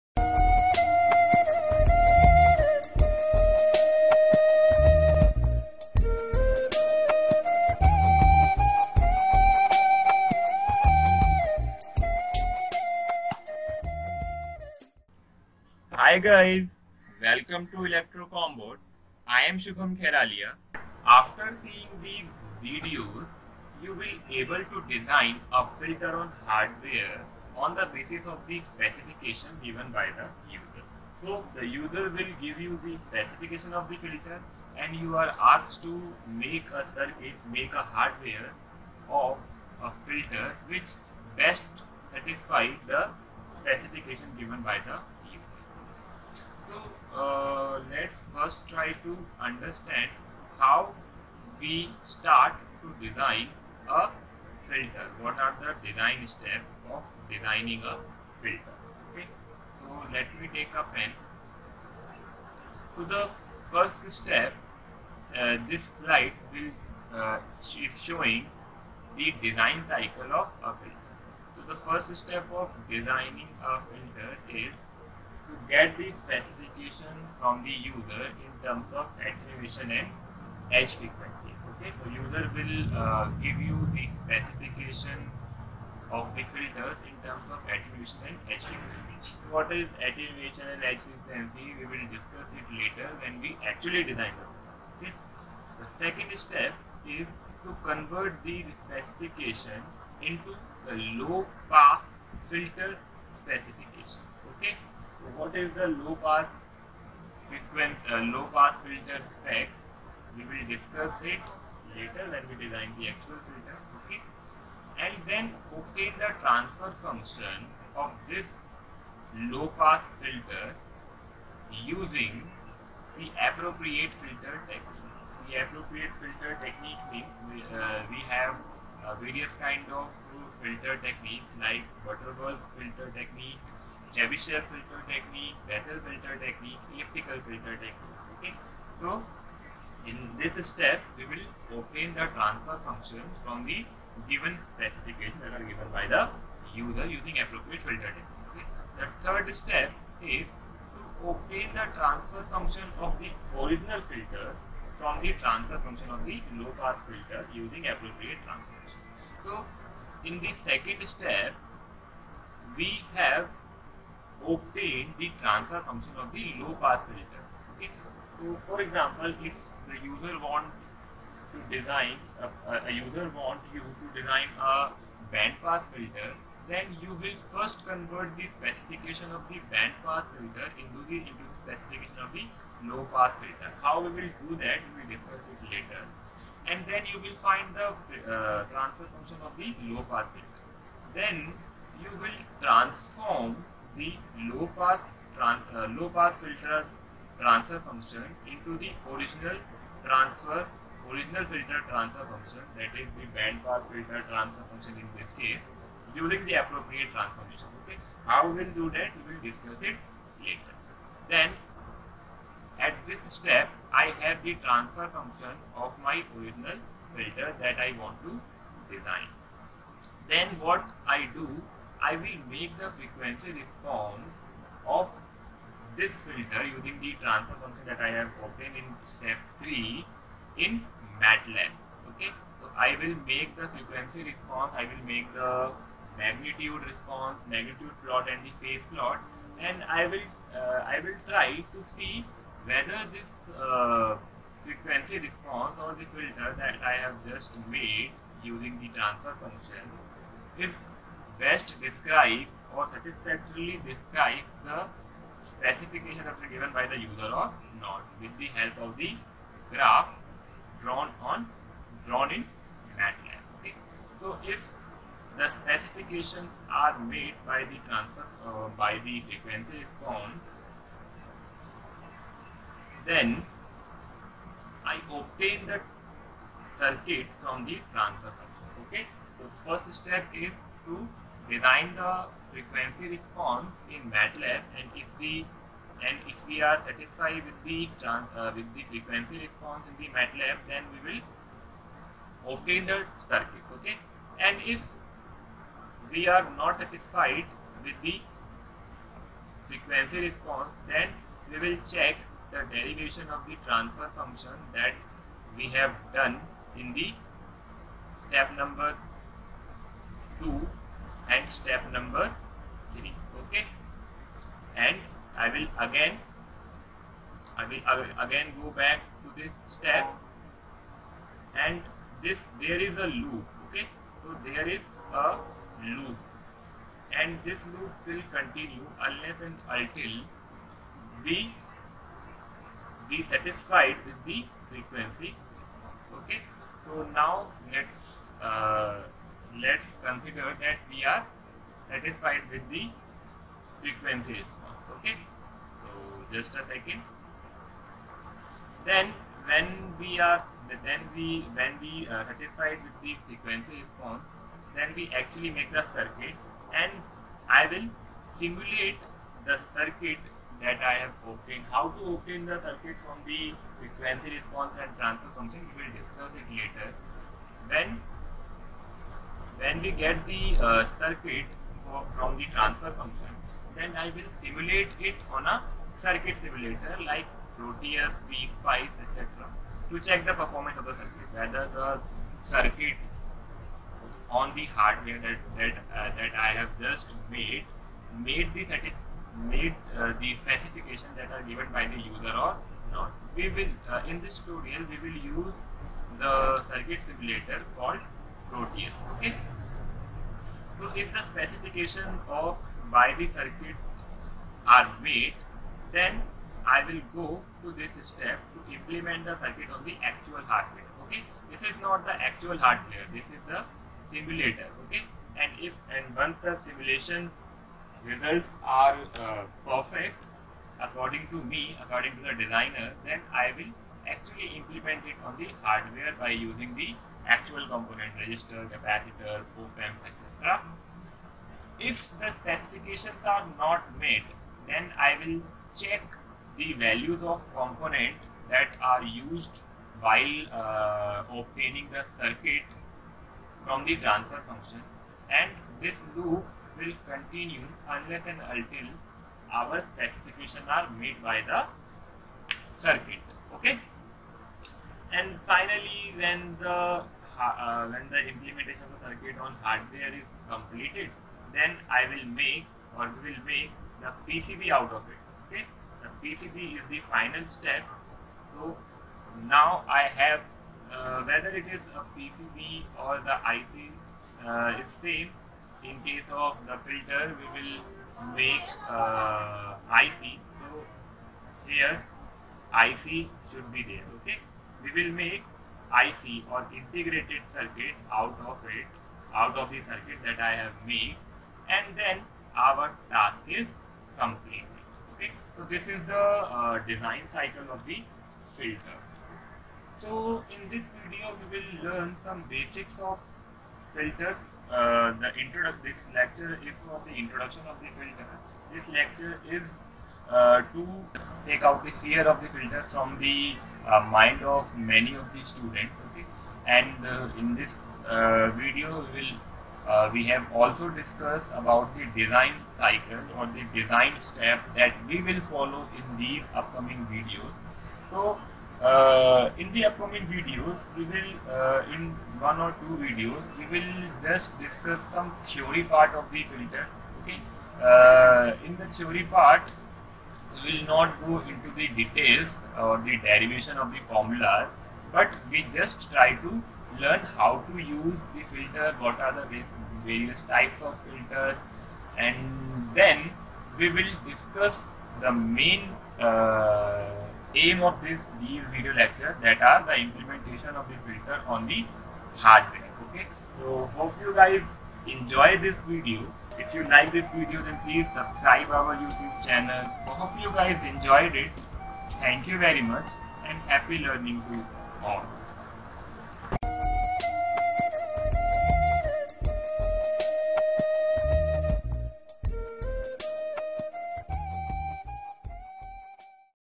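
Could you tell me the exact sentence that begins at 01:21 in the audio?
Okay, so user will uh, give you the specification of the filters in terms of attenuation and edge frequency.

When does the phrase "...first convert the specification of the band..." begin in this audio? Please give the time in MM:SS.
02:57.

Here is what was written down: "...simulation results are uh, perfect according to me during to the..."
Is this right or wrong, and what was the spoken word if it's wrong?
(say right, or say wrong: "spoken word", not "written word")
wrong: "according", not "during".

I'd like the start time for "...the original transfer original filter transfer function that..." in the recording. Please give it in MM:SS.
03:18.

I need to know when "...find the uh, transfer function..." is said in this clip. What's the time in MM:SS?
03:07.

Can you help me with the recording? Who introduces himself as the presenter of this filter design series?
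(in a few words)
Shubham Kheralia.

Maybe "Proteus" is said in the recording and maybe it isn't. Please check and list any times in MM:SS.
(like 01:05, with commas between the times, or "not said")
06:17, 06:38.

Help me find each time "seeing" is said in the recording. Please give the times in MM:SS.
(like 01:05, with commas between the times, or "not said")
00:21.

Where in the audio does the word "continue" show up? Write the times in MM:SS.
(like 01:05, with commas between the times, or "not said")
05:28, 07:27.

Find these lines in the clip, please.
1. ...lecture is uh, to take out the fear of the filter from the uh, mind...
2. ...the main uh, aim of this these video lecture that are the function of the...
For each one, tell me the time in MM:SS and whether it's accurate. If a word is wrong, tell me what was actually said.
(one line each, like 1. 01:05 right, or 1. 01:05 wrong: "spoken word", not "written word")
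1. 08:28 right
2. 09:15 wrong: "implementation", not "function".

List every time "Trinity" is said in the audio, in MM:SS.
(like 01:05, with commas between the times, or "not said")
not said.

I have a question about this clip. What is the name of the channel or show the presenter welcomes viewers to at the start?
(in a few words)
ElectroComBot.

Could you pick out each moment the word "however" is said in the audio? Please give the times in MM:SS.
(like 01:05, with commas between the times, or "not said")
not said.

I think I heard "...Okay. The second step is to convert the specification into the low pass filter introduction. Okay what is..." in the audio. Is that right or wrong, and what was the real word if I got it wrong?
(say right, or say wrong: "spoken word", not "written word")
wrong: "specification", not "introduction".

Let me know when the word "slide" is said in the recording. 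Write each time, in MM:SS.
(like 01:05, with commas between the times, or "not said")
01:05.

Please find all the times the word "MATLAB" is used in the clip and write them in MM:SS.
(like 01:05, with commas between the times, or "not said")
03:51, 04:22, 04:44, 04:50.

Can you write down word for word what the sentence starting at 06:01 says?
How to obtain the circuit from the frequency response and transfer function we will discuss it later.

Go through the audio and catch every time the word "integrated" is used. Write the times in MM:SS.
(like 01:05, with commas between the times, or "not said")
08:06.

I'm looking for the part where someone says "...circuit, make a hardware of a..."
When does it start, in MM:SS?
00:36.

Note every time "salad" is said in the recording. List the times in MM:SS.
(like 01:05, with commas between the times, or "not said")
not said.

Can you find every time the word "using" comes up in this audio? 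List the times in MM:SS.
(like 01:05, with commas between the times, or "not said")
02:01, 02:27, 02:37, 03:46, 04:08, 07:06.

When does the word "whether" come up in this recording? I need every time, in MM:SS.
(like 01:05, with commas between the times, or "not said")
04:02, 06:21, 07:51.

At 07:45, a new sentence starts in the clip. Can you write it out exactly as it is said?
Okay, the PCB is the final step.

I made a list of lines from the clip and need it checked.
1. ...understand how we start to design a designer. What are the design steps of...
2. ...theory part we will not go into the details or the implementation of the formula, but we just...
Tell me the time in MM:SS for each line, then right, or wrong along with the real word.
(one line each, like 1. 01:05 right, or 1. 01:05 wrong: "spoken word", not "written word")
1. 00:49 wrong: "filter", not "designer"
2. 08:58 wrong: "derivation", not "implementation".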